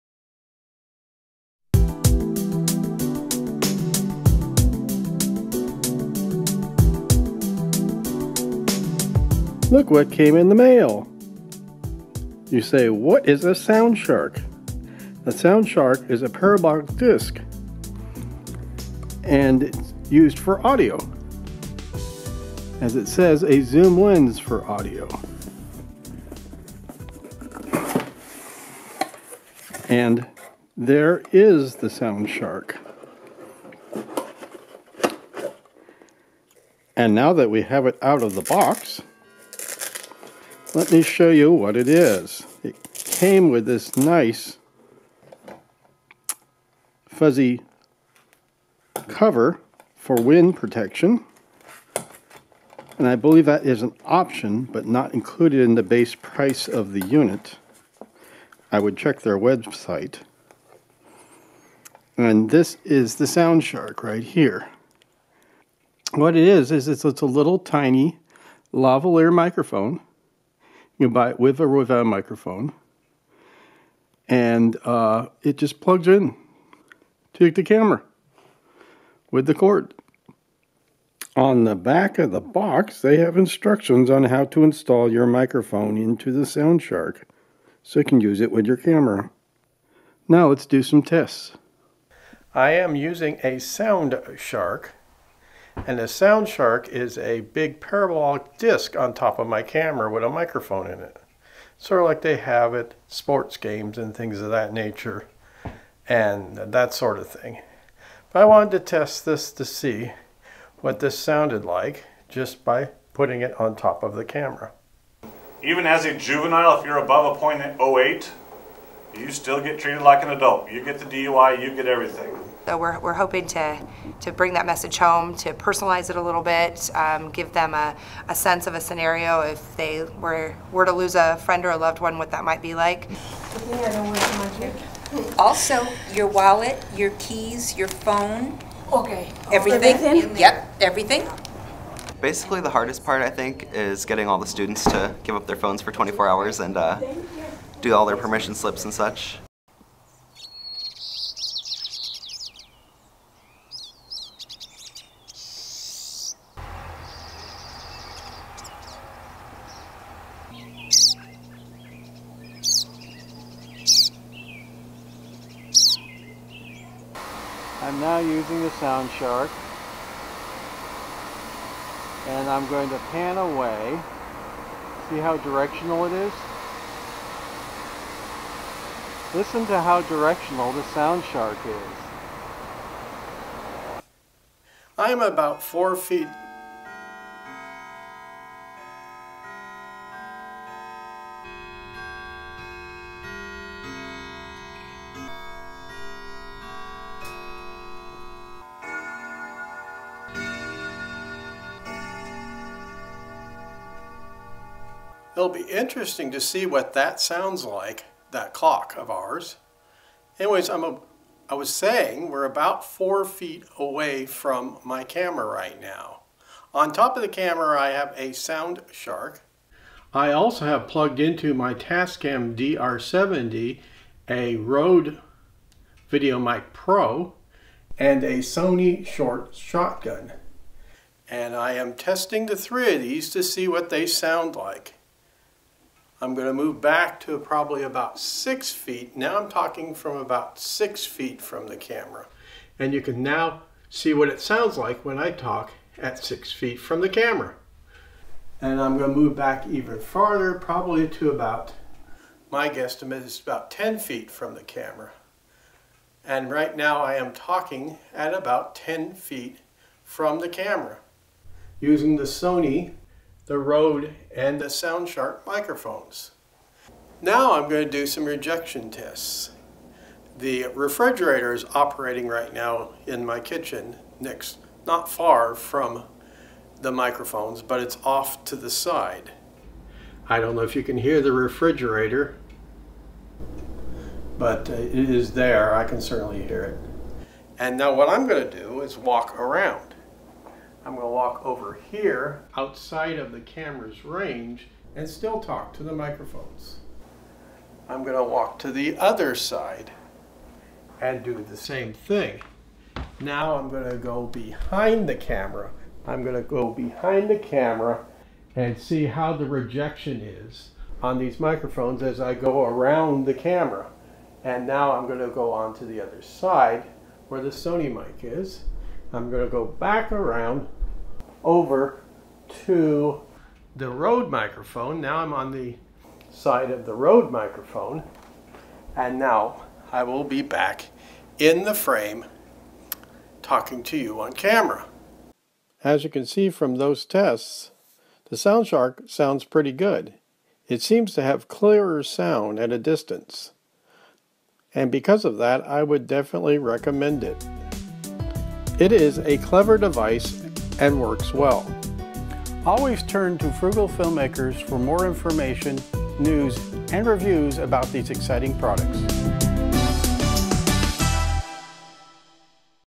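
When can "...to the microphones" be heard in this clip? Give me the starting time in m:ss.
4:55.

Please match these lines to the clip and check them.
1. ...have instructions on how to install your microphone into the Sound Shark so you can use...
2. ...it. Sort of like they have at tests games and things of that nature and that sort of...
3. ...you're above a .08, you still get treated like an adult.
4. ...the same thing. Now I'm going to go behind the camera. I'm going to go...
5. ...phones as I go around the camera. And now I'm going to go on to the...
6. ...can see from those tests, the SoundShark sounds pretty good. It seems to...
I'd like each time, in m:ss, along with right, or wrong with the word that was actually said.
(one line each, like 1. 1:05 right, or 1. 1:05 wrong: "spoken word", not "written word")
1. 1:23 right
2. 1:40 wrong: "sports", not "tests"
3. 1:56 right
4. 5:01 right
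5. 5:11 wrong: "microphones", not "phones"
6. 5:36 right.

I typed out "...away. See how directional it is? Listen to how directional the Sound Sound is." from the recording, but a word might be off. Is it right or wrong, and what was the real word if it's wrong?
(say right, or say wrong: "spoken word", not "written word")
wrong: "Shark", not "Sound".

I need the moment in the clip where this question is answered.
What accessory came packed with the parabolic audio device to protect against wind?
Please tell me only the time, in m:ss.
0:47.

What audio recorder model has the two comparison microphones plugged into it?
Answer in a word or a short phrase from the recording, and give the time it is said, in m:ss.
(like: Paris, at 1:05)
Tascam DR70, at 3:41.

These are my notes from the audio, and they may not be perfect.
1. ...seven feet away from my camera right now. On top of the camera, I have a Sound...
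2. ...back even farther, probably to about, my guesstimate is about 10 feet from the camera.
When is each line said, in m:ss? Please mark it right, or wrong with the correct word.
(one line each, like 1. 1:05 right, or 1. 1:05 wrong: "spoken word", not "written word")
1. 3:32 wrong: "four", not "seven"
2. 4:09 right.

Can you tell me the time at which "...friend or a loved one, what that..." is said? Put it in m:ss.
2:11.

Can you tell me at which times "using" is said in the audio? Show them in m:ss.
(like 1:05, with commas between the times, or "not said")
1:32, 2:48, 4:21.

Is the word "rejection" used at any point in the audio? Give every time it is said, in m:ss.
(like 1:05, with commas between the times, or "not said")
4:28, 5:09.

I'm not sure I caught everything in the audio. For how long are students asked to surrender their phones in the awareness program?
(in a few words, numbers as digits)
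24 hours.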